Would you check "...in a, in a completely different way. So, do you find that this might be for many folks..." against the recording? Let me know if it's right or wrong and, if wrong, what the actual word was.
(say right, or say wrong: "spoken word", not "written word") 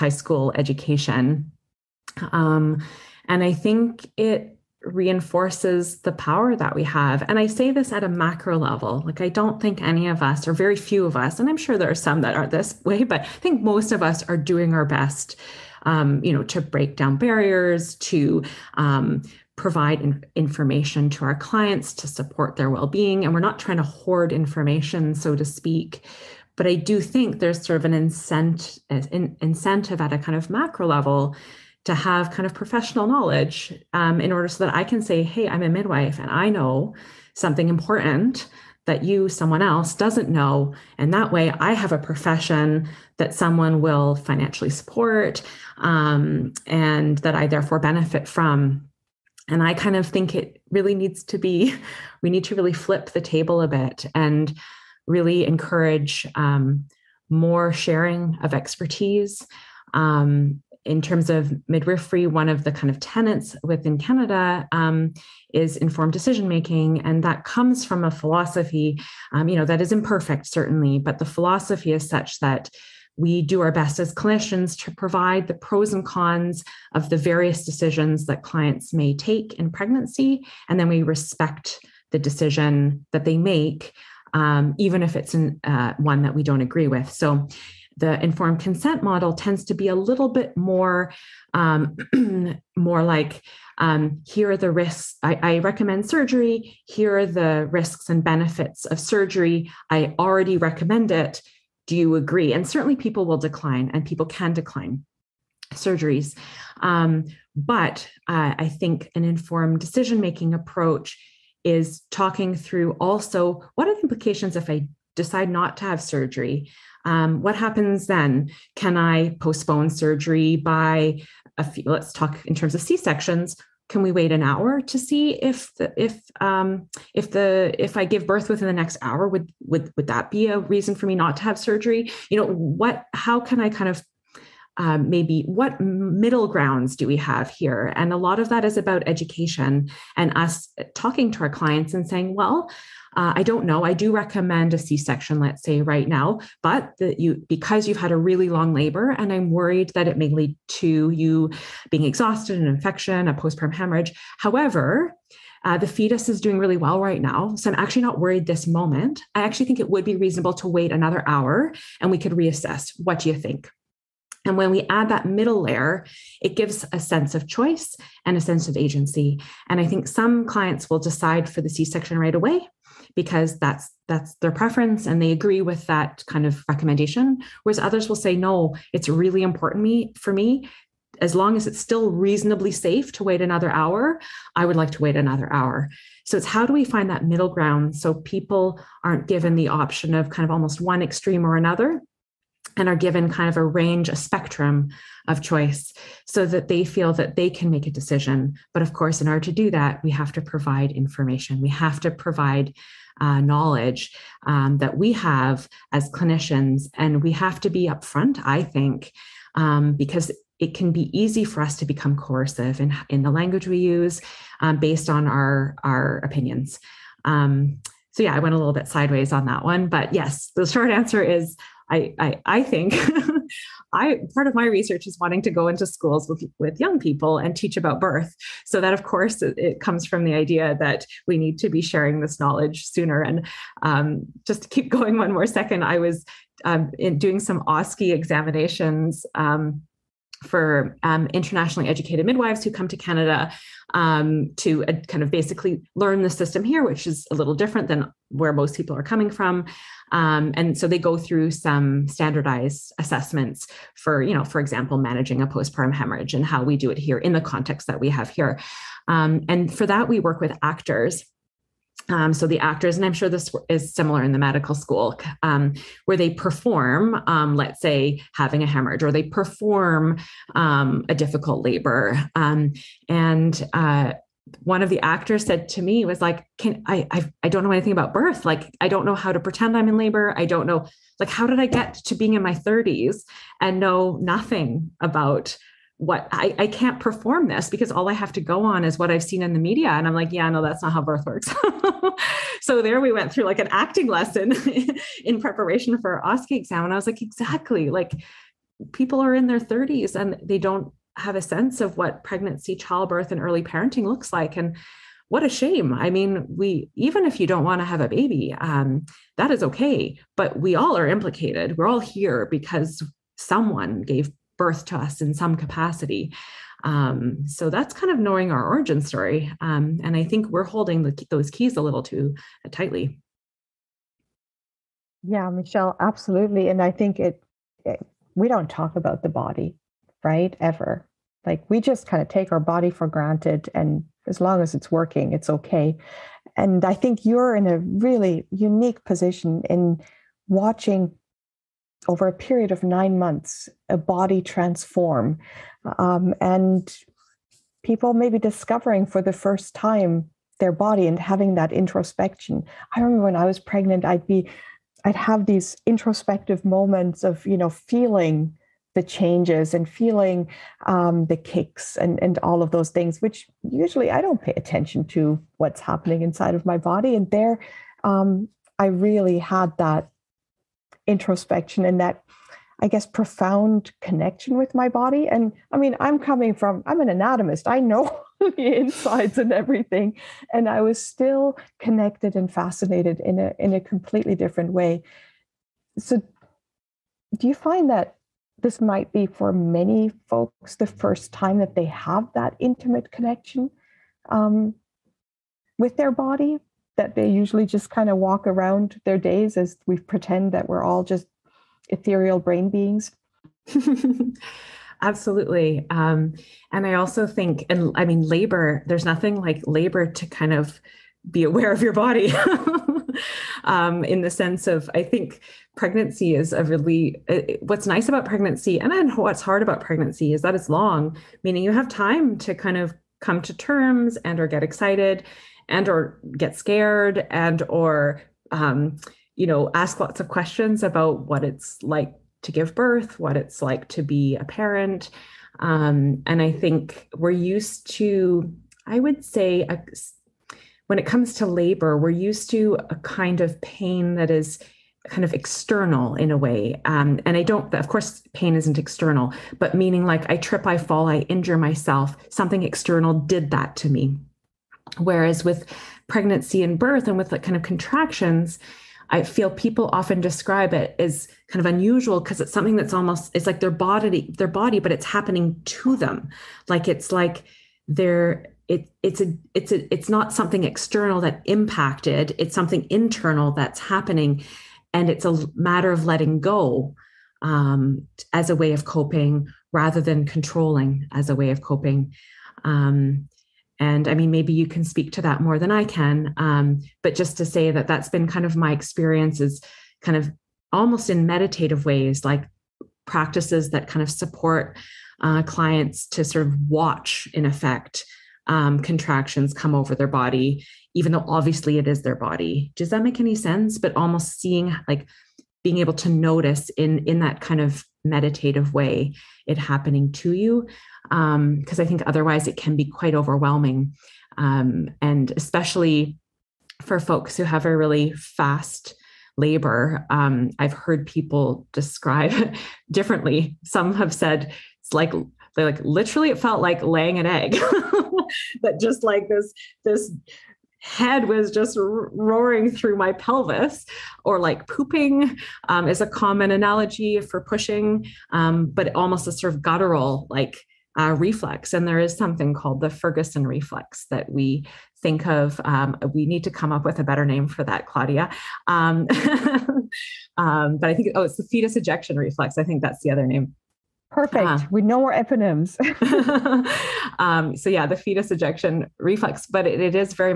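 right.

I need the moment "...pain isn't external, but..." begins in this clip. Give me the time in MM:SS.
07:28.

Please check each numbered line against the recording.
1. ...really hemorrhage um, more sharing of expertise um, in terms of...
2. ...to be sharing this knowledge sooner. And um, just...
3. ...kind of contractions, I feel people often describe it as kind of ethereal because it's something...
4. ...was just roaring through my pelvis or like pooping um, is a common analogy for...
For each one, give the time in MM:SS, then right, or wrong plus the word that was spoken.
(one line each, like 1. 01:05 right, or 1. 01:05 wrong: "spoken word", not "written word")
1. 00:55 wrong: "encourage", not "hemorrhage"
2. 03:51 right
3. 07:37 wrong: "unusual", not "ethereal"
4. 08:51 right.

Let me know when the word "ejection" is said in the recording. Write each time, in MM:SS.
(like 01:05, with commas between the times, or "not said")
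09:11, 09:18.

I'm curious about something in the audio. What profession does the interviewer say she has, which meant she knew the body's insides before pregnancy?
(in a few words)
anatomist.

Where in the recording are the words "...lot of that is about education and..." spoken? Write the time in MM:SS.
02:18.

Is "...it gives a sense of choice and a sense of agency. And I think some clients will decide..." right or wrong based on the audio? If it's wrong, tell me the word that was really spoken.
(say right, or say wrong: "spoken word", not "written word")
right.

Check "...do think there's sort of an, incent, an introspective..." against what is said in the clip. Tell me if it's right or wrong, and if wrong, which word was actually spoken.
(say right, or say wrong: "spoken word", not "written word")
wrong: "incentive", not "introspective".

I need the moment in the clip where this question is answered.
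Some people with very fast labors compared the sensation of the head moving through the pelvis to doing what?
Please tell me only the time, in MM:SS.
08:46.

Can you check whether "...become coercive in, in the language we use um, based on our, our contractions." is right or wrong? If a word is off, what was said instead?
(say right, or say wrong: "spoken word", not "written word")
wrong: "opinions", not "contractions".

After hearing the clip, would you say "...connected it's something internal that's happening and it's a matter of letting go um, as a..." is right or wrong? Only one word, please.
wrong.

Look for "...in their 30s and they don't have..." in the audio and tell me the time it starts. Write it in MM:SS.
04:59.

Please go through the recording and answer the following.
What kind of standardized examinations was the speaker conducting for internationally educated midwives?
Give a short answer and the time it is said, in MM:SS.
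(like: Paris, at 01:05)
OSCE examinations, at 03:57.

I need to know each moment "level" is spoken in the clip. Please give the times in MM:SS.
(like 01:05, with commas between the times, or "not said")
00:08, 00:30.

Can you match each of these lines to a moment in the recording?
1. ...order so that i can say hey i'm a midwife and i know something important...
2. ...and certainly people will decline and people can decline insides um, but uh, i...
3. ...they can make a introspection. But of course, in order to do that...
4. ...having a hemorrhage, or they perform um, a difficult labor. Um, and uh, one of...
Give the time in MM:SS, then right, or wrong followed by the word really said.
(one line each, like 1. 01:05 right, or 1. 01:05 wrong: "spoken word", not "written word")
1. 00:34 right
2. 01:42 wrong: "surgeries", not "insides"
3. 03:17 wrong: "decision", not "introspection"
4. 04:28 right.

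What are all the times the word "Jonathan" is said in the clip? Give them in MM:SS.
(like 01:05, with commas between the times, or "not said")
not said.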